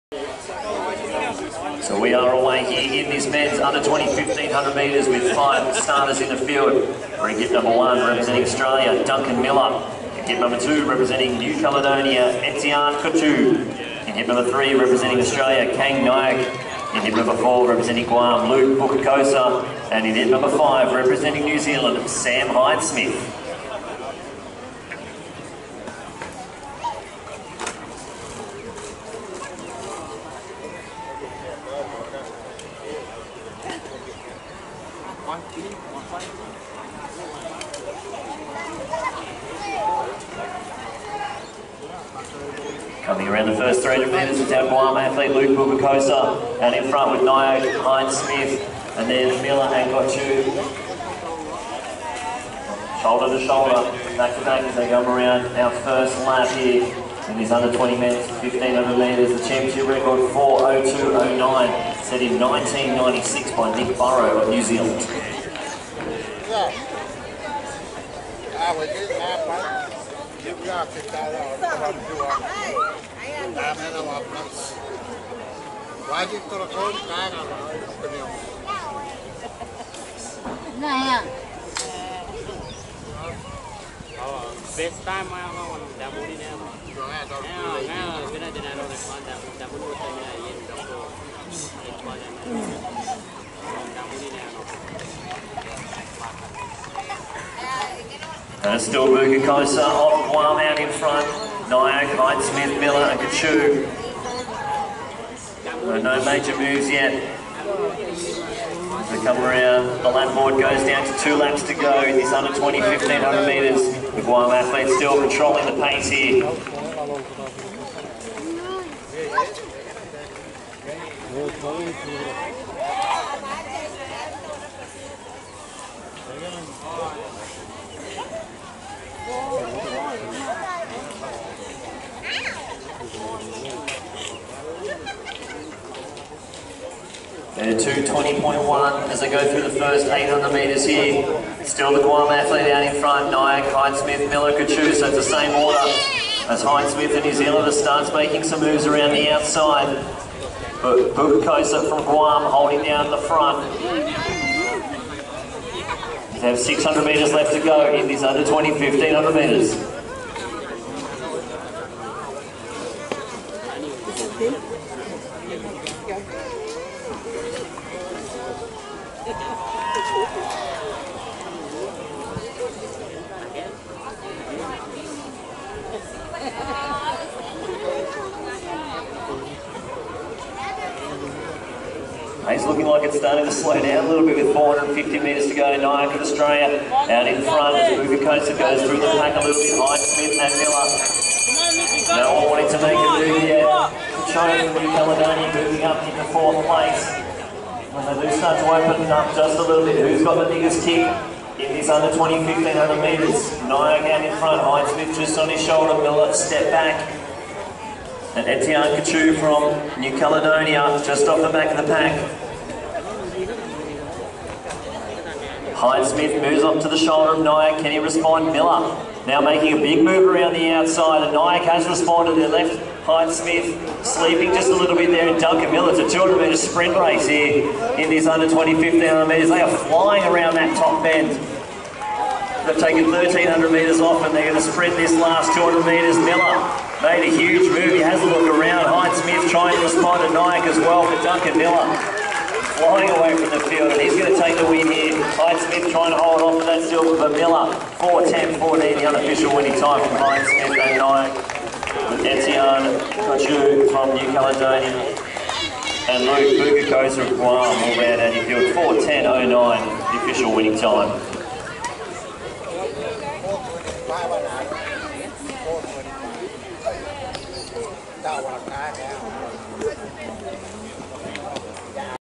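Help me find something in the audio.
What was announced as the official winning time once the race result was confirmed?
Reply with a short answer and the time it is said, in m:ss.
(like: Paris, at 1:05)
4:10.09, at 4:18.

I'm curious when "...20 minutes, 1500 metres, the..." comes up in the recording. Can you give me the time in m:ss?
0:57.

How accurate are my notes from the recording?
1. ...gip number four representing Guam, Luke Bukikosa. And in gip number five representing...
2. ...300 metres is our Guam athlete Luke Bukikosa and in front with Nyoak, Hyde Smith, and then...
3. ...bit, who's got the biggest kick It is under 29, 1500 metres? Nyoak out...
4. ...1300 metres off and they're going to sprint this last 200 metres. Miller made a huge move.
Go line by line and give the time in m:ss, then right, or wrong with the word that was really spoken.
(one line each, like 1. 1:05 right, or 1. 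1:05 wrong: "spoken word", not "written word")
1. 0:17 right
2. 0:43 right
3. 3:19 wrong: "20", not "29"
4. 3:53 right.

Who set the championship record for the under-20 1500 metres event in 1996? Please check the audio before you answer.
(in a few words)
Nick Burrow.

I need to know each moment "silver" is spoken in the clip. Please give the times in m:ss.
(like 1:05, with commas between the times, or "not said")
4:06.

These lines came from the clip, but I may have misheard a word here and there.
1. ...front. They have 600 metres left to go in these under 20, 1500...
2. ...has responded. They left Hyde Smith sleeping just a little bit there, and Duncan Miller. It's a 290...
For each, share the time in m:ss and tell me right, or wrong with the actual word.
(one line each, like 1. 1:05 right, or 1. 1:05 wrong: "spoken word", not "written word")
1. 2:33 right
2. 3:41 wrong: "200", not "290".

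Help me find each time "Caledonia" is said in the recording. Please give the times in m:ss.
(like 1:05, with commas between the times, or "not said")
0:11, 3:14, 3:30, 4:14.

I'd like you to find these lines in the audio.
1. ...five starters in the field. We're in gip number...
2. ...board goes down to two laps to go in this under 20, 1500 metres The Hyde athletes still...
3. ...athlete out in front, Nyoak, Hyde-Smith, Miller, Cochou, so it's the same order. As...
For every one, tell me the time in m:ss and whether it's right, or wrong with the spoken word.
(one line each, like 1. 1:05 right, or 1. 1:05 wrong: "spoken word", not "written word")
1. 0:05 right
2. 1:50 wrong: "Guam", not "Hyde"
3. 2:22 right.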